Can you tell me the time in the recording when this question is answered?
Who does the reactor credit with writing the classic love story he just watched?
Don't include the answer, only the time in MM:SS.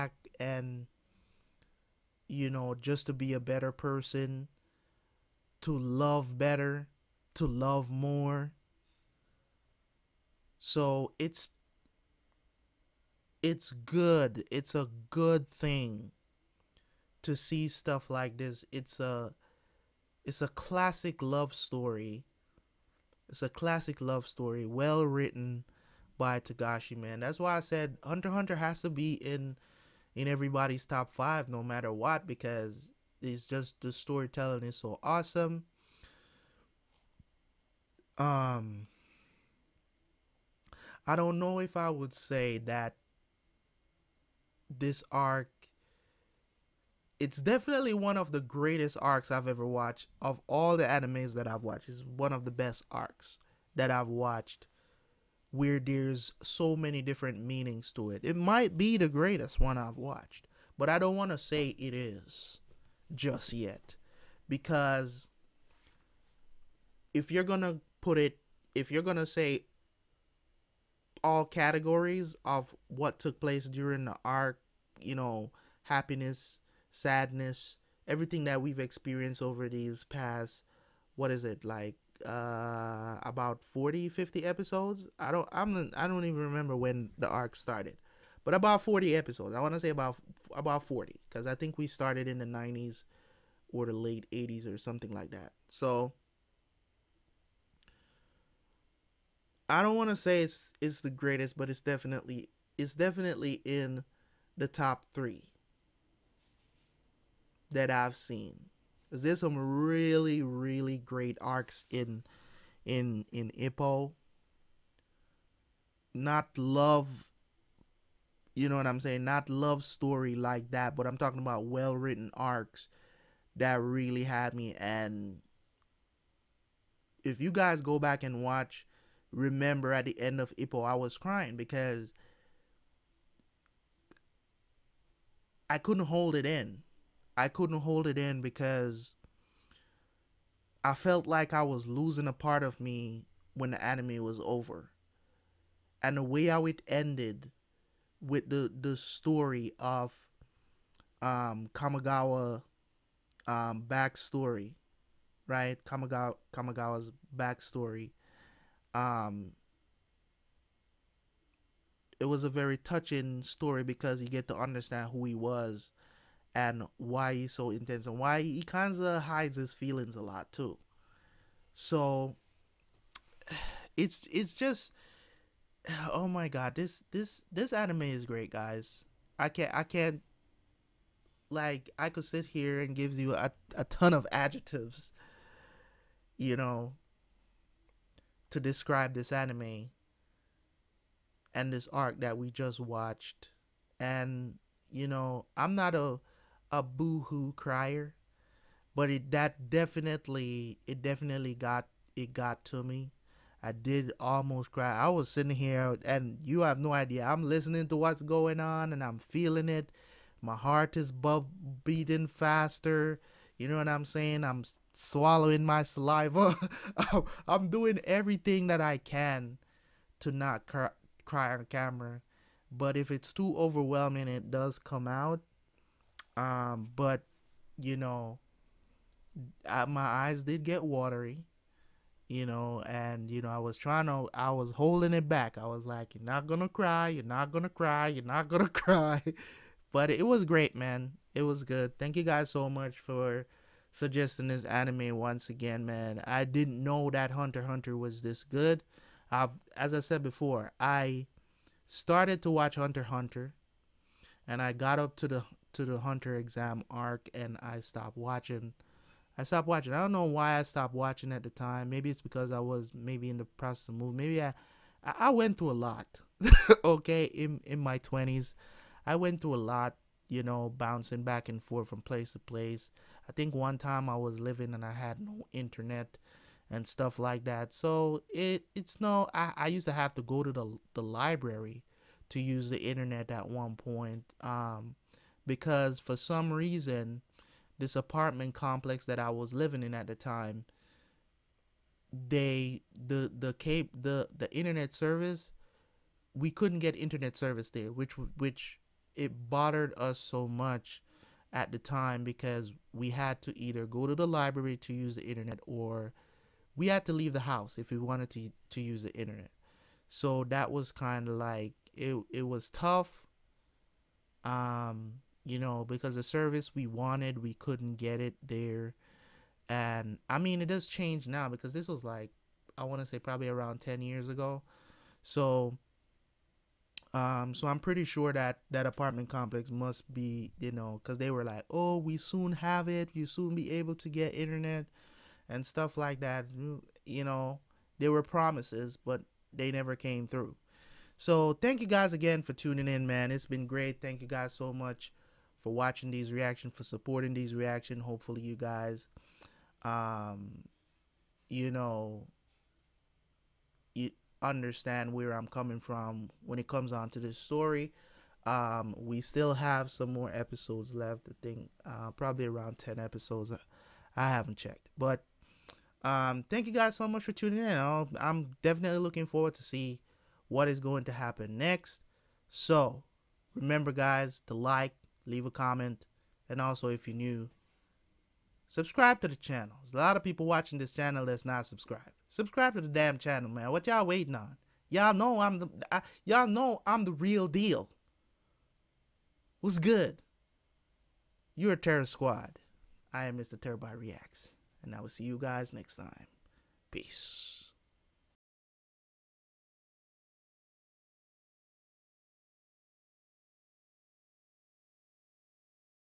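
00:26.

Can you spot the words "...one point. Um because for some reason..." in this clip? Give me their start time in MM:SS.
04:43.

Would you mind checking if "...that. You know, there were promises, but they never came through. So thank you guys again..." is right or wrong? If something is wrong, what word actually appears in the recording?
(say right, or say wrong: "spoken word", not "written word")
right.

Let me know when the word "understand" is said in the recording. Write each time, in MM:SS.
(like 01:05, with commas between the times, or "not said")
02:44, 05:54.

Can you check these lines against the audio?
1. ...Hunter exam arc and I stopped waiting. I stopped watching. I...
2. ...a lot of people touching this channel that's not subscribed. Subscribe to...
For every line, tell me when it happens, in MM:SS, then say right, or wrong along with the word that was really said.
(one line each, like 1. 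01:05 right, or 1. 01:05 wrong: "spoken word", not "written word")
1. 04:15 wrong: "watching", not "waiting"
2. 06:19 wrong: "watching", not "touching".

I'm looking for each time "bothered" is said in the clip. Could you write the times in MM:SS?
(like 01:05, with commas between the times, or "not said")
04:59.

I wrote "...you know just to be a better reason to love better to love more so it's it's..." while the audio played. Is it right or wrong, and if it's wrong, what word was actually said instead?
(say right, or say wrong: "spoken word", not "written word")
wrong: "person", not "reason".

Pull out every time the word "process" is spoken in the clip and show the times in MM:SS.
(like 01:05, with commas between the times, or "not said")
04:23.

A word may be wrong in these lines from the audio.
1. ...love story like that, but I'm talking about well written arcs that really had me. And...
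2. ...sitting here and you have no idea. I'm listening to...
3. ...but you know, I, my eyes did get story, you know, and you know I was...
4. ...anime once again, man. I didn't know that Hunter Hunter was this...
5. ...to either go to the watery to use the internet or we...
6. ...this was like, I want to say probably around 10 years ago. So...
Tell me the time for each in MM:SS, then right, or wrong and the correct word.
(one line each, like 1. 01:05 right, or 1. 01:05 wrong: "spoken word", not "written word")
1. 01:59 right
2. 03:25 right
3. 03:46 wrong: "watery", not "story"
4. 04:04 right
5. 05:03 wrong: "library", not "watery"
6. 05:21 right.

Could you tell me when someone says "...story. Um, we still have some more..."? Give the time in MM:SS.
05:57.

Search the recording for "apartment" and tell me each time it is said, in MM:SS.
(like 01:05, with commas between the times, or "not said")
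04:47, 05:28.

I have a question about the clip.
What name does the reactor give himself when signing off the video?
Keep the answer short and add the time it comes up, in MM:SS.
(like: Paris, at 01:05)
Mr. Turbo Reacts, at 06:33.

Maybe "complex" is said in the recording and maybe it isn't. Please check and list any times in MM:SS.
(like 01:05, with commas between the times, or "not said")
04:48, 05:29.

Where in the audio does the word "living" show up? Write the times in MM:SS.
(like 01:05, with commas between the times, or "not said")
04:34, 04:49.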